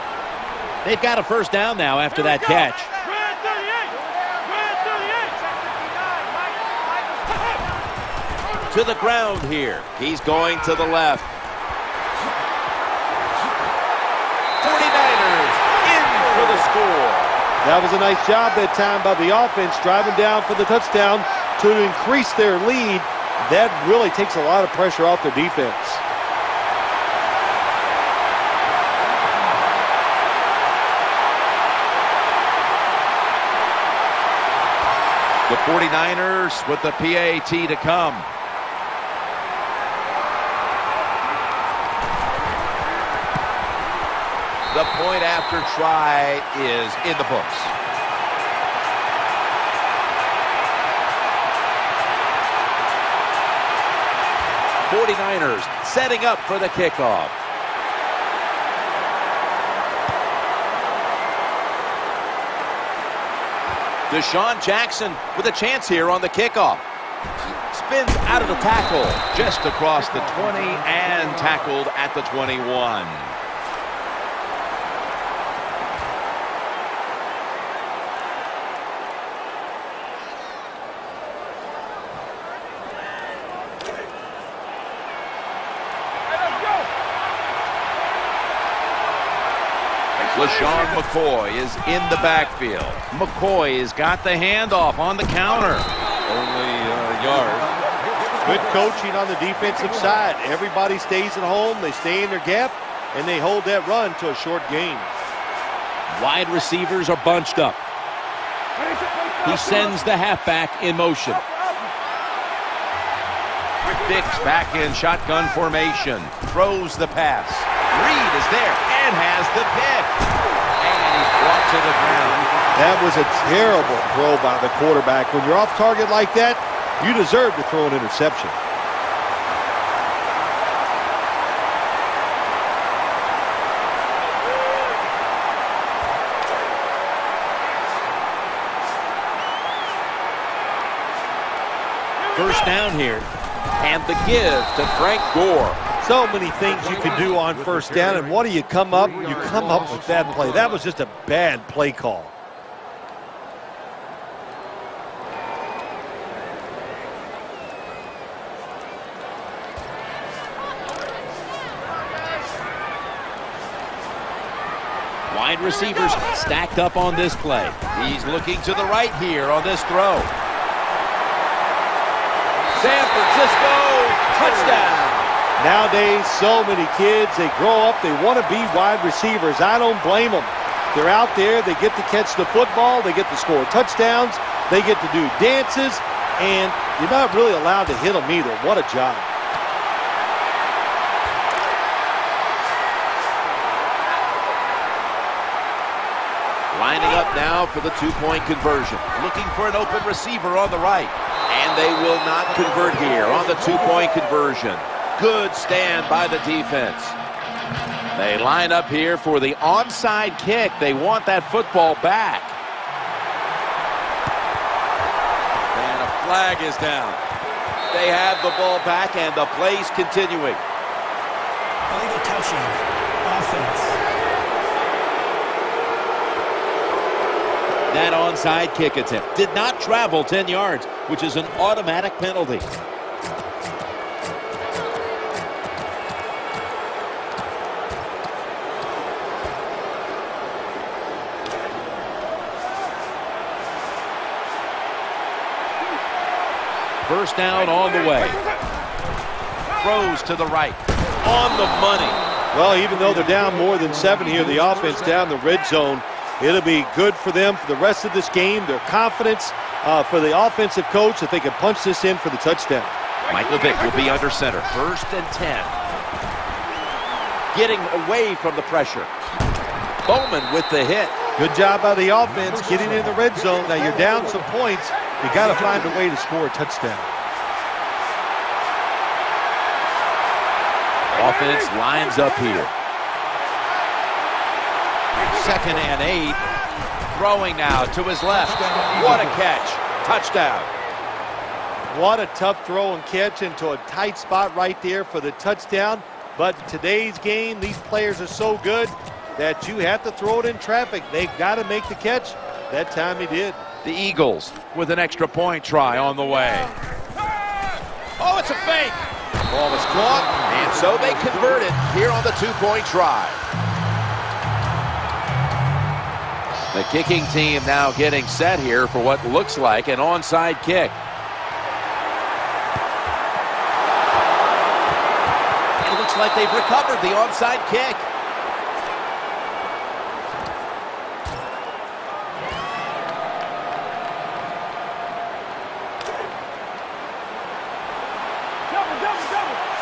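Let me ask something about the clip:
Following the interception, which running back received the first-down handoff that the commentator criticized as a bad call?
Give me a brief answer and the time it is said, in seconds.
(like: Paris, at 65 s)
Frank Gore, at 144 s.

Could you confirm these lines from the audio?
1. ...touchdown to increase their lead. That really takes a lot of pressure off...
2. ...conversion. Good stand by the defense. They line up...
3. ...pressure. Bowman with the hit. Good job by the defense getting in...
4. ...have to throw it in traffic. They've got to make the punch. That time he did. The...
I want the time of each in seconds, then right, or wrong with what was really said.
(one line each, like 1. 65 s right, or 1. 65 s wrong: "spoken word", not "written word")
1. 20 s right
2. 204 s right
3. 268 s wrong: "offense", not "defense"
4. 299 s wrong: "catch", not "punch".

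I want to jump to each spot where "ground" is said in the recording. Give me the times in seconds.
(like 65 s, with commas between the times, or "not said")
8 s, 121 s.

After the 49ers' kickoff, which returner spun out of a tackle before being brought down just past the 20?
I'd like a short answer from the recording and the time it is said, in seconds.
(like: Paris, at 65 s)
DeSean Jackson, at 64 s.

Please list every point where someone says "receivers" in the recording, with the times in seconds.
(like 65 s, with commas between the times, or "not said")
106 s, 165 s, 179 s, 200 s.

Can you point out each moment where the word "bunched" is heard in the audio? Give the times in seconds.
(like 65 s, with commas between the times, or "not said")
107 s.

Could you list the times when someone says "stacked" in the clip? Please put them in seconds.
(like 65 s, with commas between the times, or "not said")
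166 s.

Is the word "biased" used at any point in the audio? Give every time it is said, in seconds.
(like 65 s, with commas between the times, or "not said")
not said.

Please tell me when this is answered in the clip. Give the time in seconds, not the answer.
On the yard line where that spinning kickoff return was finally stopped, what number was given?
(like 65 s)
72 s.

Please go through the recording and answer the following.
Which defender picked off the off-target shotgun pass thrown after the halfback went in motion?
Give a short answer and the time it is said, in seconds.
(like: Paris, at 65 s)
Reed, at 118 s.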